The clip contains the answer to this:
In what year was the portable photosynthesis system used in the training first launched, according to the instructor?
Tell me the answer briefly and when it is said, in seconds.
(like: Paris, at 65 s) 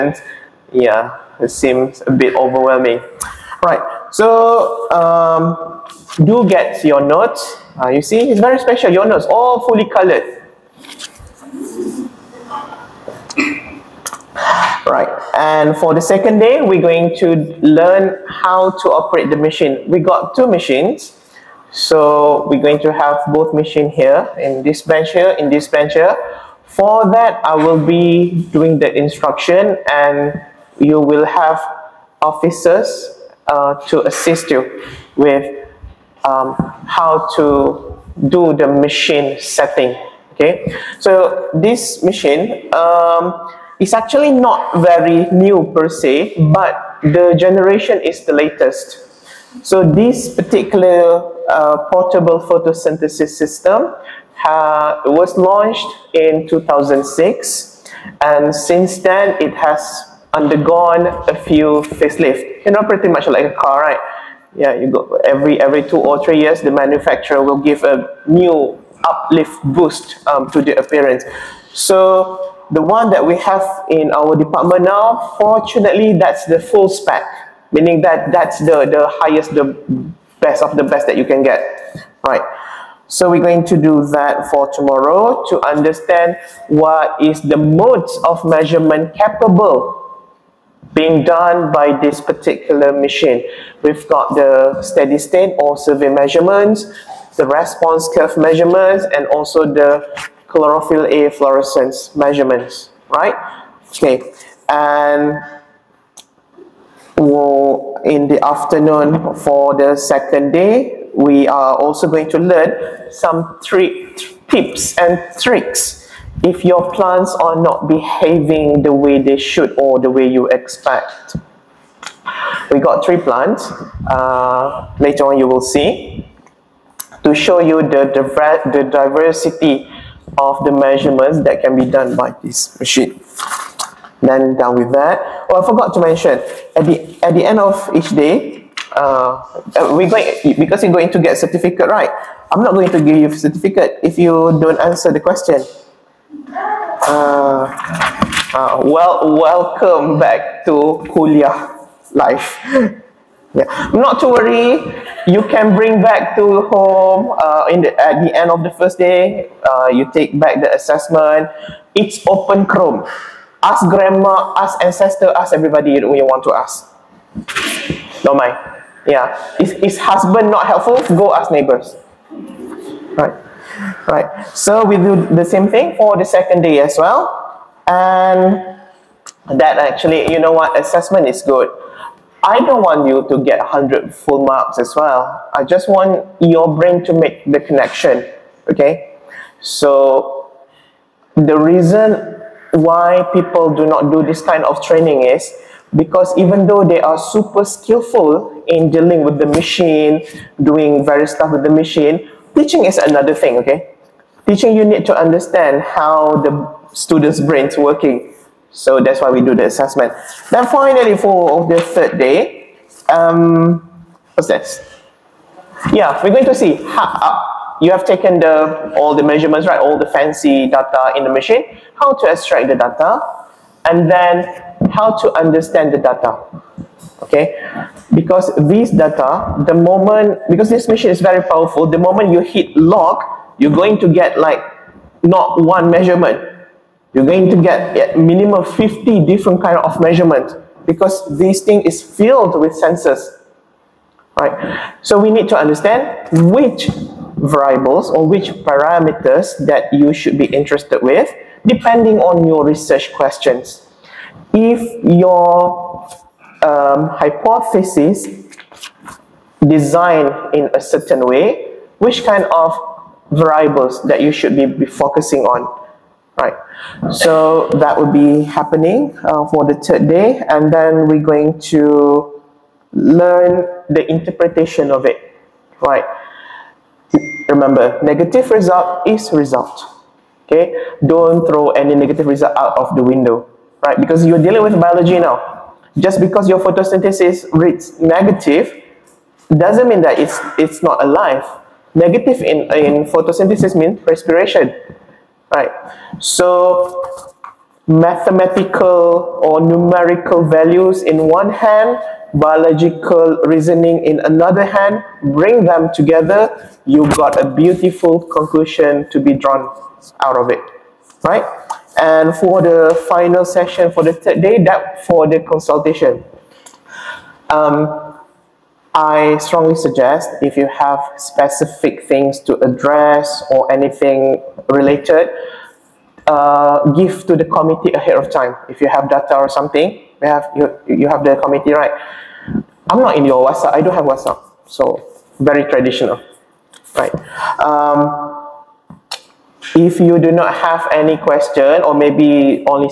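2006, at 56 s.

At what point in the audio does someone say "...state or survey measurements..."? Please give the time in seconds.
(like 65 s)
95 s.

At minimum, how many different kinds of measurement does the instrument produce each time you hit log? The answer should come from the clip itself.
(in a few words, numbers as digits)
50.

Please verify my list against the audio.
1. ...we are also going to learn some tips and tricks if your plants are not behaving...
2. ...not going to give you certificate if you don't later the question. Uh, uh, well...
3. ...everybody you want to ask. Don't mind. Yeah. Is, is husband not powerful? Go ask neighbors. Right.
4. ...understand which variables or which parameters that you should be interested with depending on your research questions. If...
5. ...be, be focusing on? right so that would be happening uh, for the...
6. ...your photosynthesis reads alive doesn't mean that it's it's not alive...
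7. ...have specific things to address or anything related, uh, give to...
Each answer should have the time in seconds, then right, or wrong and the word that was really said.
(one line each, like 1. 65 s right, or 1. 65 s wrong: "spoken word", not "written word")
1. 111 s right
2. 142 s wrong: "answer", not "later"
3. 165 s wrong: "helpful", not "powerful"
4. 245 s right
5. 264 s right
6. 286 s wrong: "negative", not "alive"
7. 320 s right.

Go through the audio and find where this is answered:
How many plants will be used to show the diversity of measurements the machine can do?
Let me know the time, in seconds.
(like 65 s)
123 s.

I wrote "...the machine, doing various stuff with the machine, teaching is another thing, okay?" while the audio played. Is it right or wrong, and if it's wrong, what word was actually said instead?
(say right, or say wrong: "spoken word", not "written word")
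right.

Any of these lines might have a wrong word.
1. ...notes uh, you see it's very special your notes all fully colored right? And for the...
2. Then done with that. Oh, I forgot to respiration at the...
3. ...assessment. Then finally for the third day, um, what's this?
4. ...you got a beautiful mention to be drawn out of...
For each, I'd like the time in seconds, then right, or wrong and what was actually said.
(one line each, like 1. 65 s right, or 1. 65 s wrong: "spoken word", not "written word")
1. 6 s right
2. 134 s wrong: "mention", not "respiration"
3. 209 s right
4. 306 s wrong: "conclusion", not "mention".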